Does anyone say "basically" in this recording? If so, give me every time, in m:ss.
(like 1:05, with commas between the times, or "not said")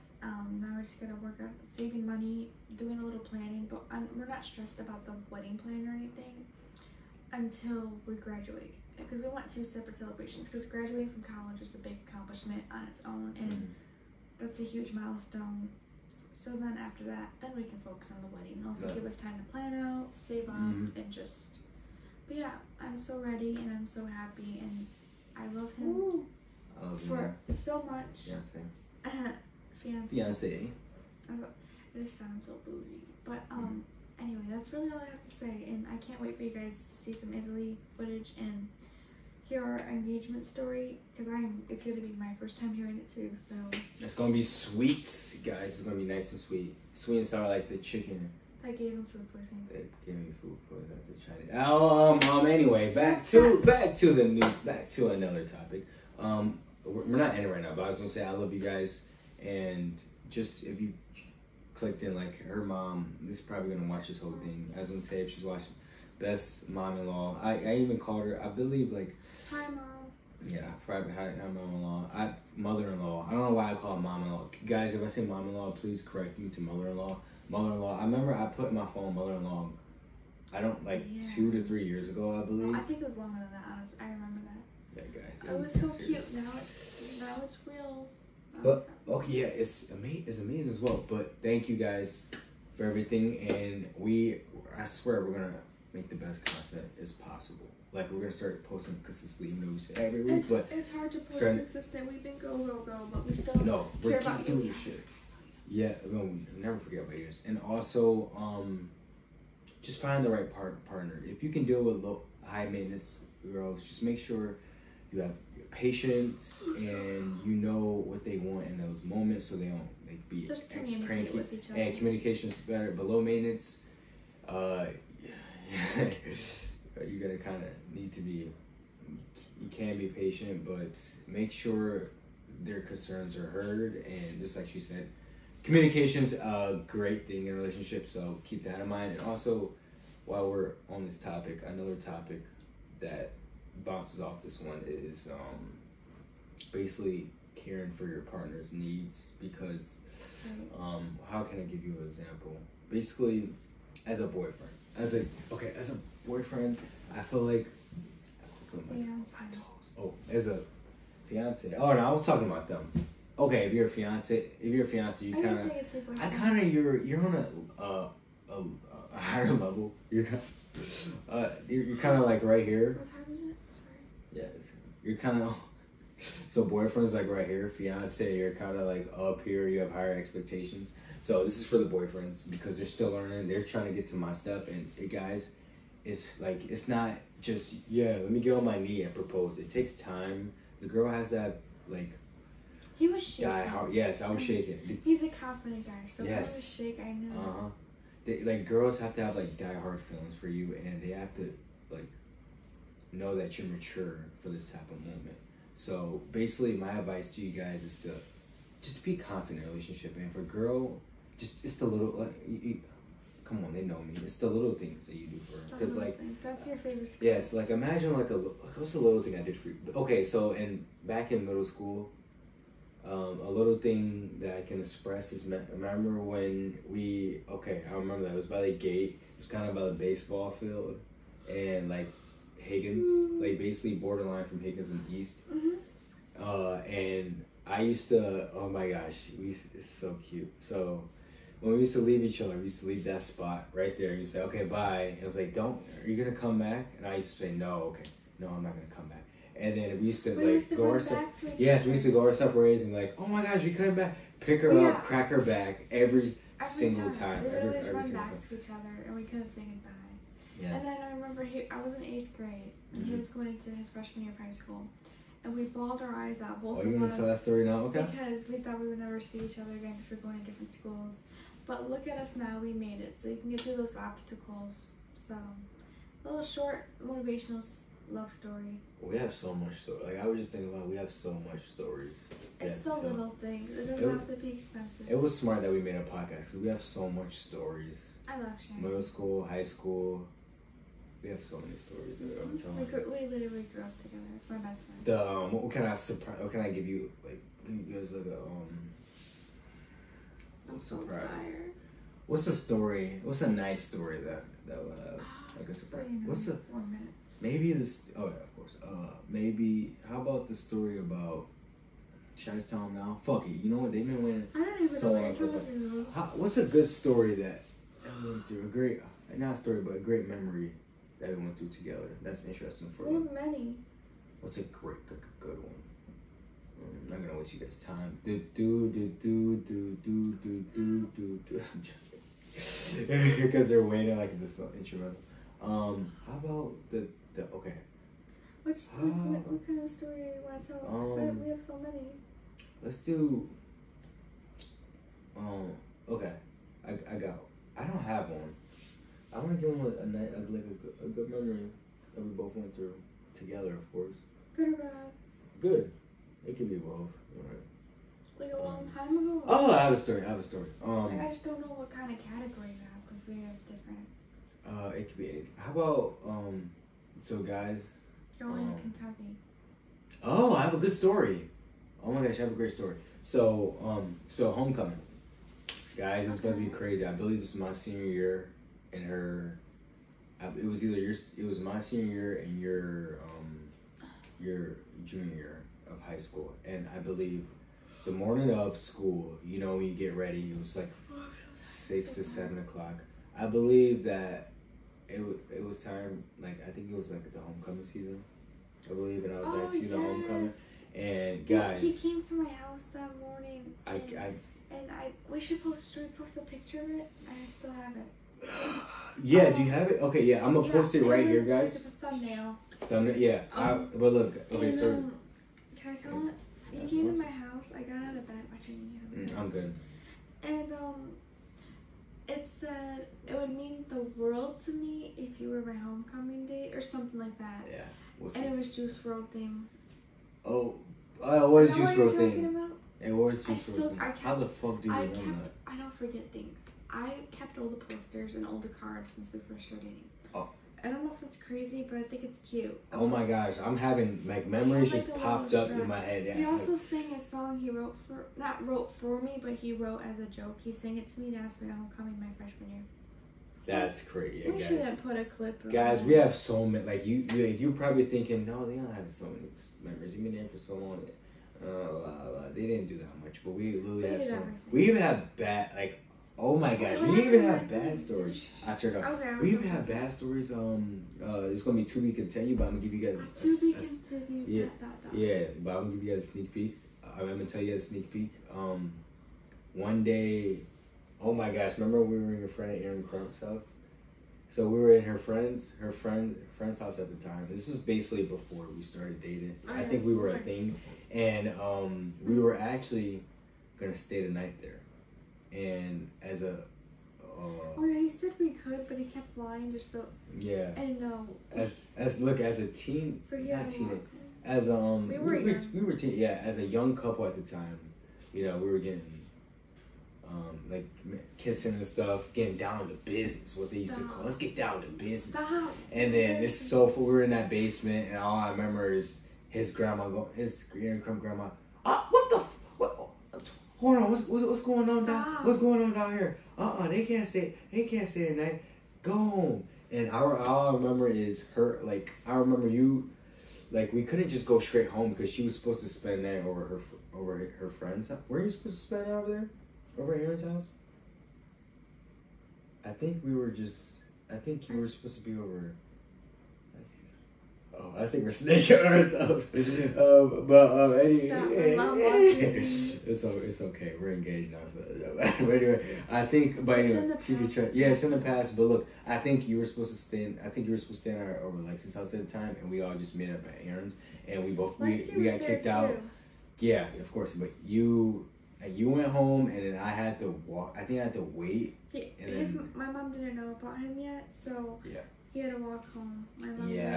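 2:26, 2:32, 3:26, 3:53, 8:07.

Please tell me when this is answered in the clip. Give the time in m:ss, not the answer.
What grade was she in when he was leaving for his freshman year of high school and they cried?
4:22.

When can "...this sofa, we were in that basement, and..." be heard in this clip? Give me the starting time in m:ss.
8:36.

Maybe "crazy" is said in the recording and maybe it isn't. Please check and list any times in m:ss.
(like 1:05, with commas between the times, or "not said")
6:16, 7:21, 7:34.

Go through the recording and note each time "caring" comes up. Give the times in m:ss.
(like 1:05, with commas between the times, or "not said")
2:27.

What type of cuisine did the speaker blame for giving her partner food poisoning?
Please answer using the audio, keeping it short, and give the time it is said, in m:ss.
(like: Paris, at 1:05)
Chinese, at 0:51.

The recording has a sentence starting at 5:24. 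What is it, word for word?
What's a great, good, good one?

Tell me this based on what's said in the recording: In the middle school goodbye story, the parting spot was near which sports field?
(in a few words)
Baseball field.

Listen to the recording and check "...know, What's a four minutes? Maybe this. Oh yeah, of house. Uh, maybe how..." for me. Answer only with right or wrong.
wrong.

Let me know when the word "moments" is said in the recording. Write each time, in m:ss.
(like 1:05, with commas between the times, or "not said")
1:59, 3:25.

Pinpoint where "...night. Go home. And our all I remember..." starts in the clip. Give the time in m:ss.
8:48.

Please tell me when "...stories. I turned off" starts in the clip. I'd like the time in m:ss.
7:47.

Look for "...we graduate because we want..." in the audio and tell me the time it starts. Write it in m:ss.
0:08.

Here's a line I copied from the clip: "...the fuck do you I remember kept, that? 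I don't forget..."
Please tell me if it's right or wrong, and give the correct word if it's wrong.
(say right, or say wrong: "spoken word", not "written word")
right.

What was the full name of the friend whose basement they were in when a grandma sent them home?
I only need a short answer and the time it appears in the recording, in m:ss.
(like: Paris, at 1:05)
Aaron Crump, at 8:02.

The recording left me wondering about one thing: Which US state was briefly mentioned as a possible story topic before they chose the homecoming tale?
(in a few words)
Kentucky.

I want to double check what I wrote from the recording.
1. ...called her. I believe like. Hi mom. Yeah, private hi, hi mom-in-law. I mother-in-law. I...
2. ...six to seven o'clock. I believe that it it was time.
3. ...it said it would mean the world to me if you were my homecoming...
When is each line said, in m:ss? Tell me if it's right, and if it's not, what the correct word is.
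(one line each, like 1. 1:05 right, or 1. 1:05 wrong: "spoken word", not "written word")
1. 1:07 right
2. 6:31 right
3. 7:02 right.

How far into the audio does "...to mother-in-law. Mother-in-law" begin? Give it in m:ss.
1:16.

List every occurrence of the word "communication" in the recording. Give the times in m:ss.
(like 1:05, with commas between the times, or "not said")
2:01, 2:15.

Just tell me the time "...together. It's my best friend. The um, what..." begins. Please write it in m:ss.
4:54.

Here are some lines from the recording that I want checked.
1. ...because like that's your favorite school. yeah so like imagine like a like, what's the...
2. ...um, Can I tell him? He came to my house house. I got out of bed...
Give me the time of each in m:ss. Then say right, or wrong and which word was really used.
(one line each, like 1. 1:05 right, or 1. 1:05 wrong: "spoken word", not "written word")
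1. 3:35 right
2. 6:54 right.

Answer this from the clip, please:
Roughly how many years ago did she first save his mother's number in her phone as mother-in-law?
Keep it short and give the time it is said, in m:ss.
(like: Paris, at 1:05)
2 to 3 years, at 1:21.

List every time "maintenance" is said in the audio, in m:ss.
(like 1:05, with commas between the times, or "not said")
1:52, 2:03.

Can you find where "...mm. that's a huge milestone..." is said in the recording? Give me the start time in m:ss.
0:13.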